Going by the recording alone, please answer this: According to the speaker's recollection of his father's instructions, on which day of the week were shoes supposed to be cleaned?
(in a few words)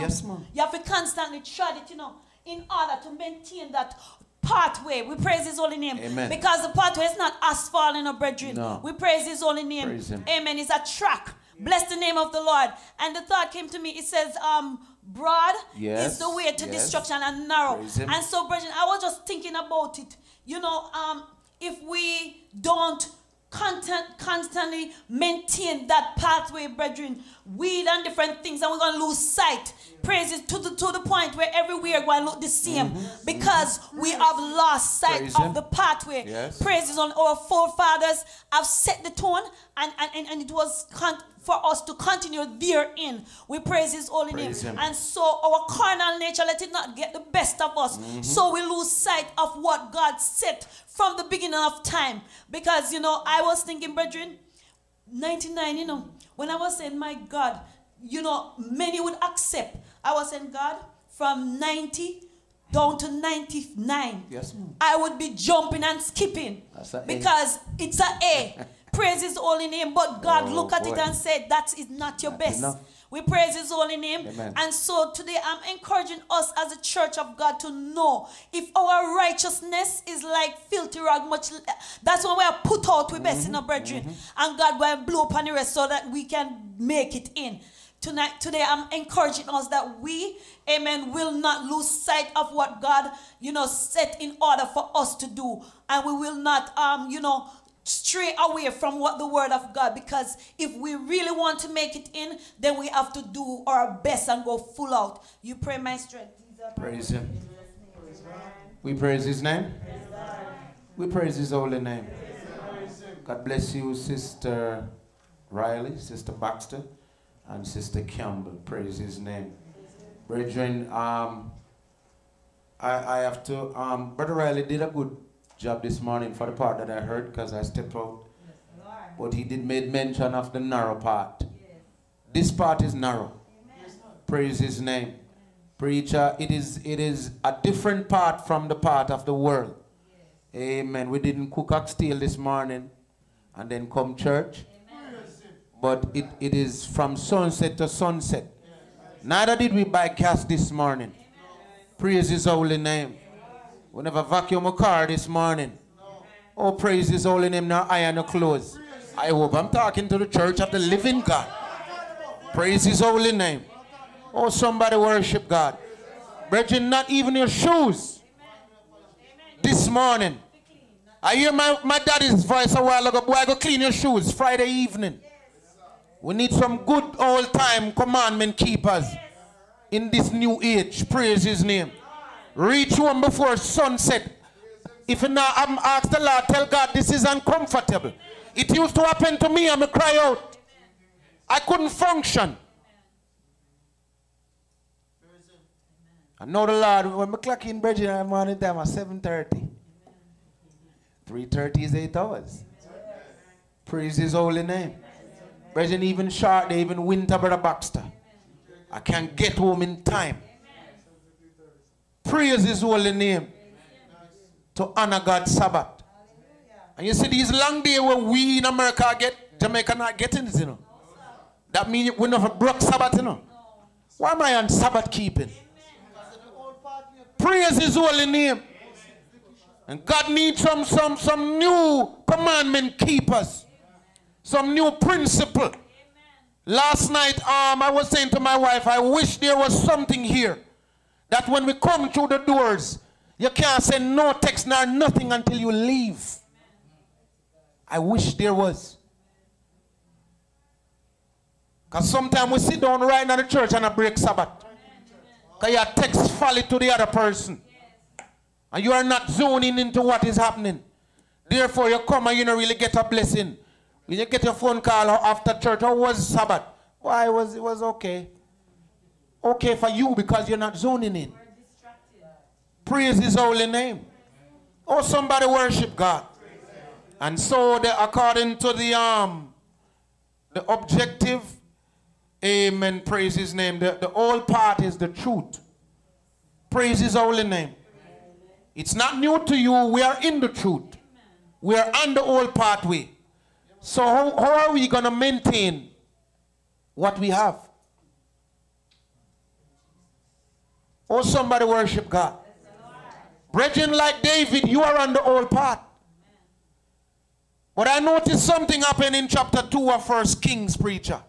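Friday.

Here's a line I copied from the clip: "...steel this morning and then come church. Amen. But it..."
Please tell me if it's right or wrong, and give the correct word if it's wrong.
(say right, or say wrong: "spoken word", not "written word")
right.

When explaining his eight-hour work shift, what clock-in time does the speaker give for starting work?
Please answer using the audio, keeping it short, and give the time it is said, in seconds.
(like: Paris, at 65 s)
7:30, at 198 s.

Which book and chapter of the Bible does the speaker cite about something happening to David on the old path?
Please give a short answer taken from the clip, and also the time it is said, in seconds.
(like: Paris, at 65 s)
1 Kings chapter 2, at 309 s.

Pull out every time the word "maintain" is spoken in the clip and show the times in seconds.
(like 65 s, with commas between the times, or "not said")
3 s, 25 s, 295 s.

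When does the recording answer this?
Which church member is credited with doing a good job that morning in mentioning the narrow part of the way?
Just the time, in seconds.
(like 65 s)
124 s.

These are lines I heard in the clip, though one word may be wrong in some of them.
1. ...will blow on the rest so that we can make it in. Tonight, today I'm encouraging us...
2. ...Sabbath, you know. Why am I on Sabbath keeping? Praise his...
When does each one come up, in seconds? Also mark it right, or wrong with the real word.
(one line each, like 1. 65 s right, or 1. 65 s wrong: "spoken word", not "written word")
1. 84 s right
2. 222 s right.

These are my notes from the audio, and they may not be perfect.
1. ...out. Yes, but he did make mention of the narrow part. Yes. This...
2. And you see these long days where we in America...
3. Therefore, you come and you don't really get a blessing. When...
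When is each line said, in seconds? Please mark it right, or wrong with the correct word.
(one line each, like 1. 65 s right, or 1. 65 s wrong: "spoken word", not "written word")
1. 127 s right
2. 216 s right
3. 261 s right.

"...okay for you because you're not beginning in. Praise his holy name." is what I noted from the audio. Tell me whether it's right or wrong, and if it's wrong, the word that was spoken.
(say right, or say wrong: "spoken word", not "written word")
wrong: "zoning", not "beginning".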